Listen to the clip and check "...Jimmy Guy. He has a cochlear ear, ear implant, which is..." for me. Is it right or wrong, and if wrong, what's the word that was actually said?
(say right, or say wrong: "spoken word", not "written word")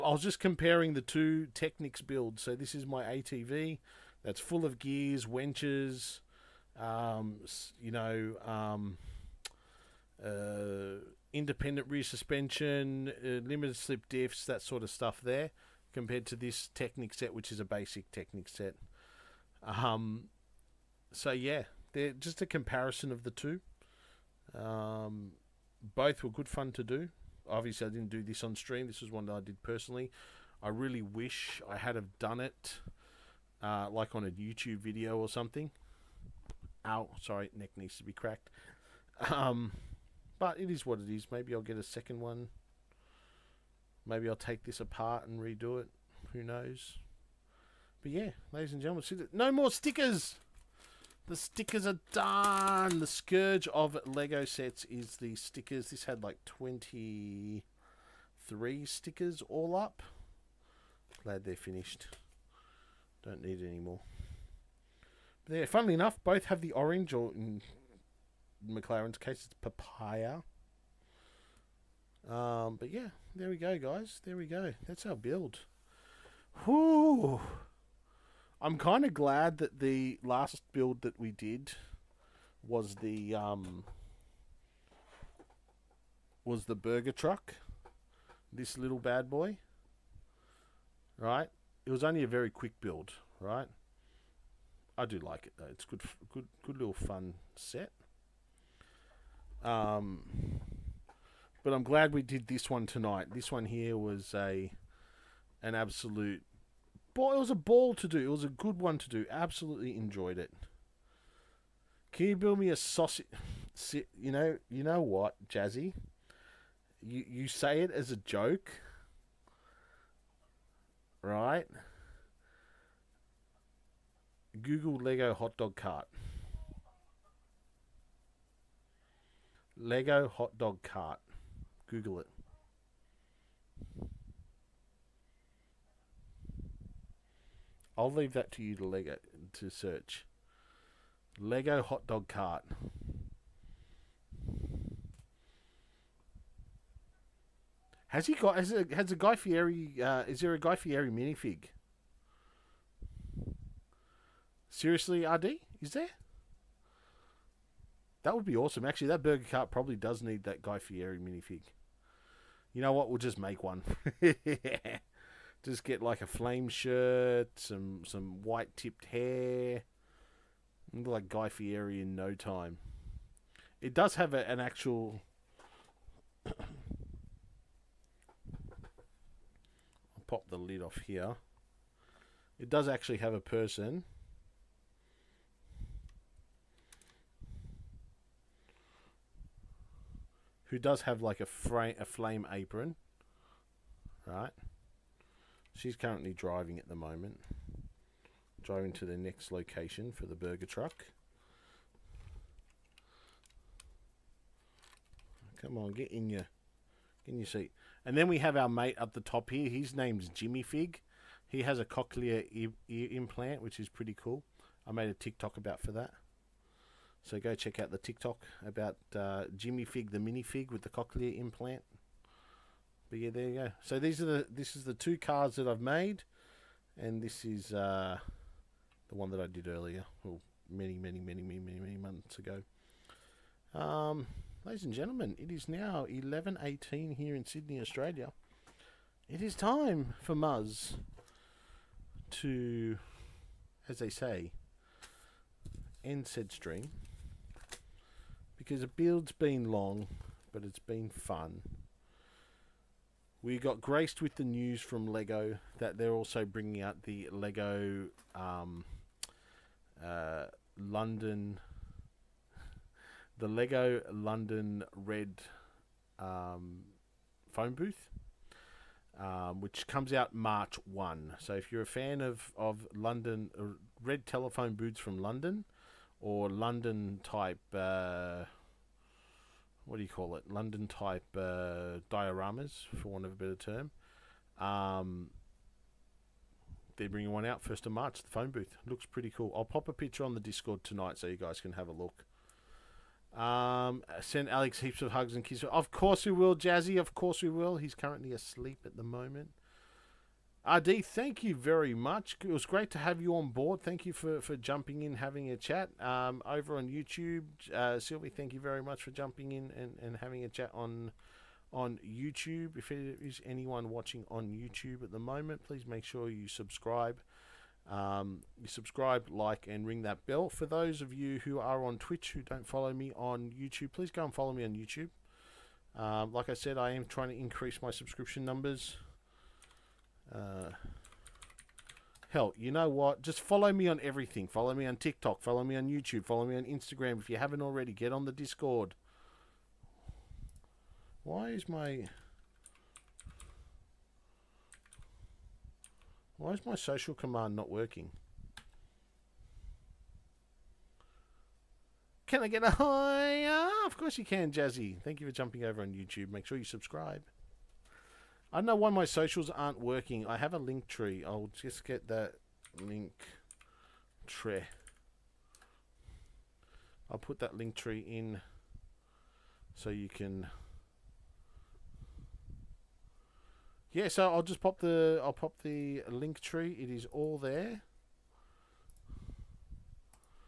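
wrong: "Fig", not "Guy".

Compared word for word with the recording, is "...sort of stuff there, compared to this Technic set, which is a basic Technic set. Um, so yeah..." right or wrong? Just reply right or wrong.
right.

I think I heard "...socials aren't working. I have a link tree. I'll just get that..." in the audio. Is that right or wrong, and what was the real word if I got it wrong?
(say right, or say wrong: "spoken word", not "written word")
right.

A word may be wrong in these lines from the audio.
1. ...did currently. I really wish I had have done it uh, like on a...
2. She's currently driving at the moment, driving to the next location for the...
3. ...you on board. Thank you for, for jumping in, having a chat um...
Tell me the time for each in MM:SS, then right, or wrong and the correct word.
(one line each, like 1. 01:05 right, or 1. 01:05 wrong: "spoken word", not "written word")
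1. 00:29 wrong: "personally", not "currently"
2. 03:15 right
3. 05:03 right.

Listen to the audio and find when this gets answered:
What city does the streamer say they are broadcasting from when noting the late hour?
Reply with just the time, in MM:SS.
03:57.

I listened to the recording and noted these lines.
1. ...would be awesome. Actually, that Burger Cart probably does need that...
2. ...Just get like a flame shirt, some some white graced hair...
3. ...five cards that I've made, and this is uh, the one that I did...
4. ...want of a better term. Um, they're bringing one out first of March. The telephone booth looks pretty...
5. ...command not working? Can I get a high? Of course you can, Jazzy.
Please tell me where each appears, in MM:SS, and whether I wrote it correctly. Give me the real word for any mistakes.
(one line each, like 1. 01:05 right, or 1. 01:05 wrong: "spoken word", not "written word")
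1. 02:38 right
2. 02:45 wrong: "tipped", not "graced"
3. 03:44 wrong: "two", not "five"
4. 04:43 wrong: "phone", not "telephone"
5. 05:47 right.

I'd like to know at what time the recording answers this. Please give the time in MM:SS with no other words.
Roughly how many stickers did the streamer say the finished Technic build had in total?
00:56.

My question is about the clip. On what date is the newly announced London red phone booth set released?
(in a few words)
March 1.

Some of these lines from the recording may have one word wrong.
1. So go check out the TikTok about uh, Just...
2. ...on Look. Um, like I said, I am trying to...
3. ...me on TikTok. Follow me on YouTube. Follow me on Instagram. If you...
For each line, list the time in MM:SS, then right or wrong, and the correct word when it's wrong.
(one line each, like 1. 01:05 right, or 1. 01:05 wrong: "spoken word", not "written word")
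1. 03:37 wrong: "Jimmy", not "Just"
2. 05:24 wrong: "YouTube", not "Look"
3. 05:34 right.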